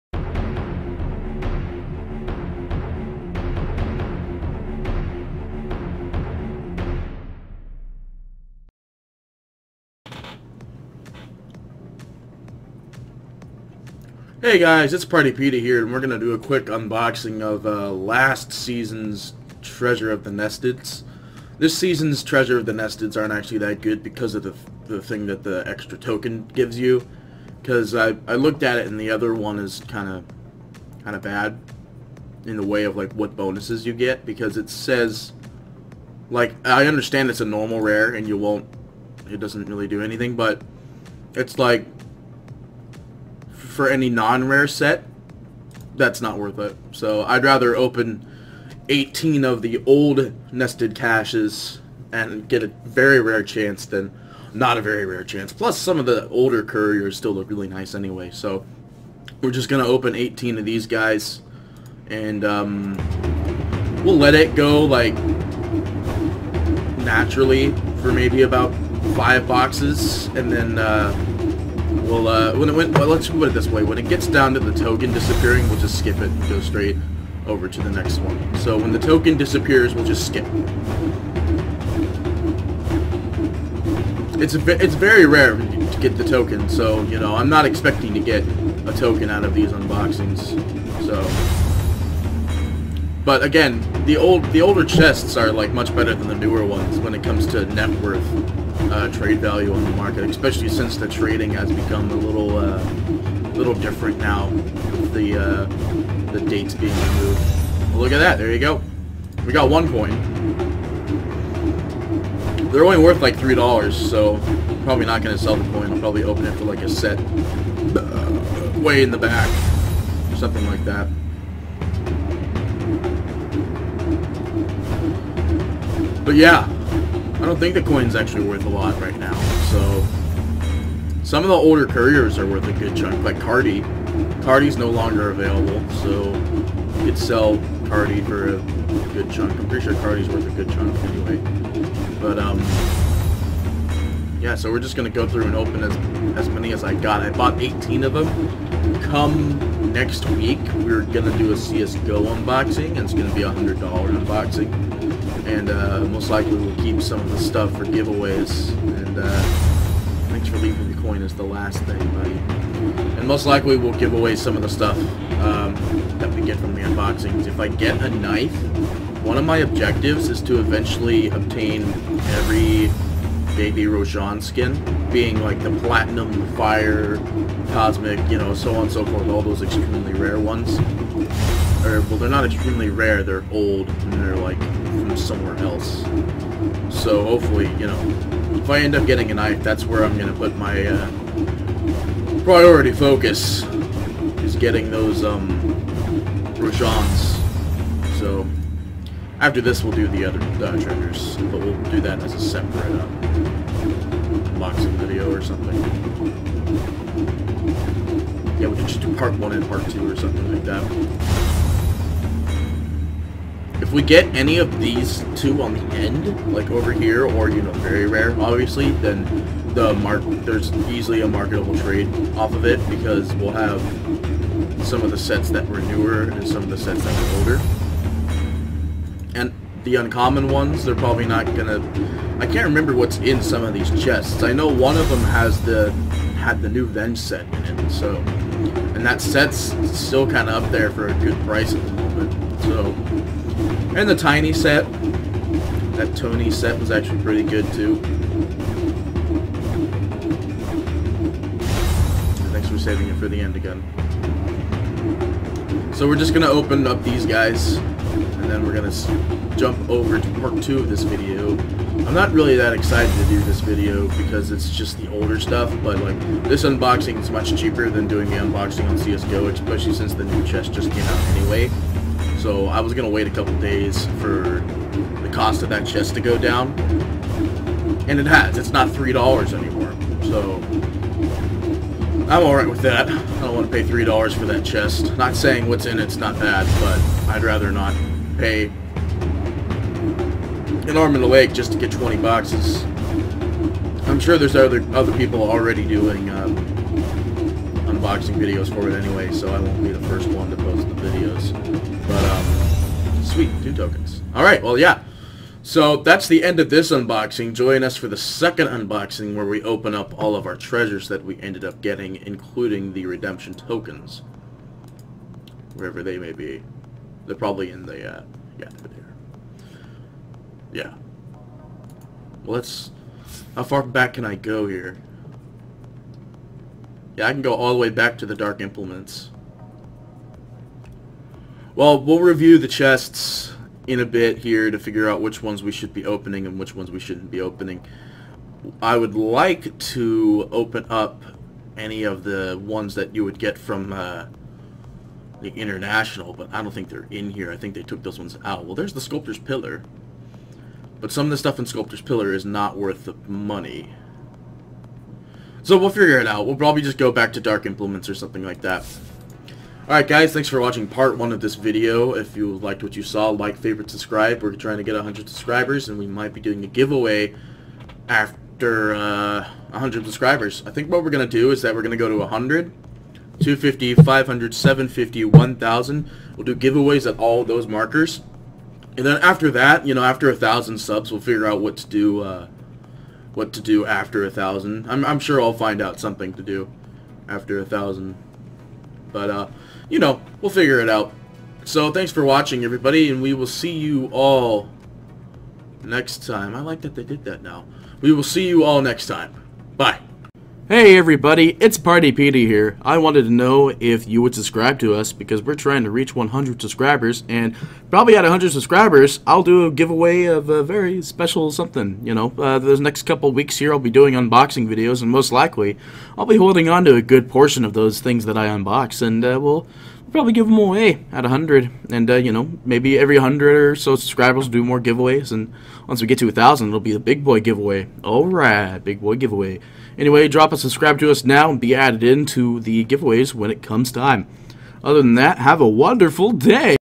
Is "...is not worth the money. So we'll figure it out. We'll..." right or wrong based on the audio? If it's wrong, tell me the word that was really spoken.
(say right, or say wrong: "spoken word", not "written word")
right.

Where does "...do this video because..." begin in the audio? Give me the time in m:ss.
4:23.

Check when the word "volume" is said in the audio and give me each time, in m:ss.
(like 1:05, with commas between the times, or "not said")
not said.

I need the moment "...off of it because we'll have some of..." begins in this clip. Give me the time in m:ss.
3:42.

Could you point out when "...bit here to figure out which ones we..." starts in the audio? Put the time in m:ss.
5:34.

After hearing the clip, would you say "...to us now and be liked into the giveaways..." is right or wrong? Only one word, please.
wrong.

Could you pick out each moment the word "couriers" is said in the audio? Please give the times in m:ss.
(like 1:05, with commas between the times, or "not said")
0:56, 2:11.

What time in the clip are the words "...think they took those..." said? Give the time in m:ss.
5:47.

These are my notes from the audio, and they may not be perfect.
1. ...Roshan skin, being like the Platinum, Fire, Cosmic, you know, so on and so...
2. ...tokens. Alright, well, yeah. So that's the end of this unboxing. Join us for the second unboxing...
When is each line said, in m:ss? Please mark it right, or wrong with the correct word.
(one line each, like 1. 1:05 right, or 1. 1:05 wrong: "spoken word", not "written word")
1. 2:53 right
2. 5:03 right.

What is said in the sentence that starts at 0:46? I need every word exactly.
So I'd rather open 18 of the old nested caches and get a very rare chance than not a very rare chance.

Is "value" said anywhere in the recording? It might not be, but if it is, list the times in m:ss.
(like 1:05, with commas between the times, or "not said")
1:39.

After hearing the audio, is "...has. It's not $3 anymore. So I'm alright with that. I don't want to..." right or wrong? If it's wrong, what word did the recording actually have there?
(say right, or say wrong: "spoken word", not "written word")
right.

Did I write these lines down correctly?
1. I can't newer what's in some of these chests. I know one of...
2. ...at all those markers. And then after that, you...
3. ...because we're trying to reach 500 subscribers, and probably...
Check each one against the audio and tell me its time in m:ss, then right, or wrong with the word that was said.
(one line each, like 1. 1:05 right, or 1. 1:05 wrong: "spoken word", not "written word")
1. 3:52 wrong: "remember", not "newer"
2. 6:17 right
3. 6:45 wrong: "100", not "500".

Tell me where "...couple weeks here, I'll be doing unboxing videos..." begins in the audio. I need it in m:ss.
6:53.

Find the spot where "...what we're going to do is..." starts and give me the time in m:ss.
6:10.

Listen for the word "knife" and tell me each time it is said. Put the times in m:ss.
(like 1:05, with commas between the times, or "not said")
2:48, 3:09.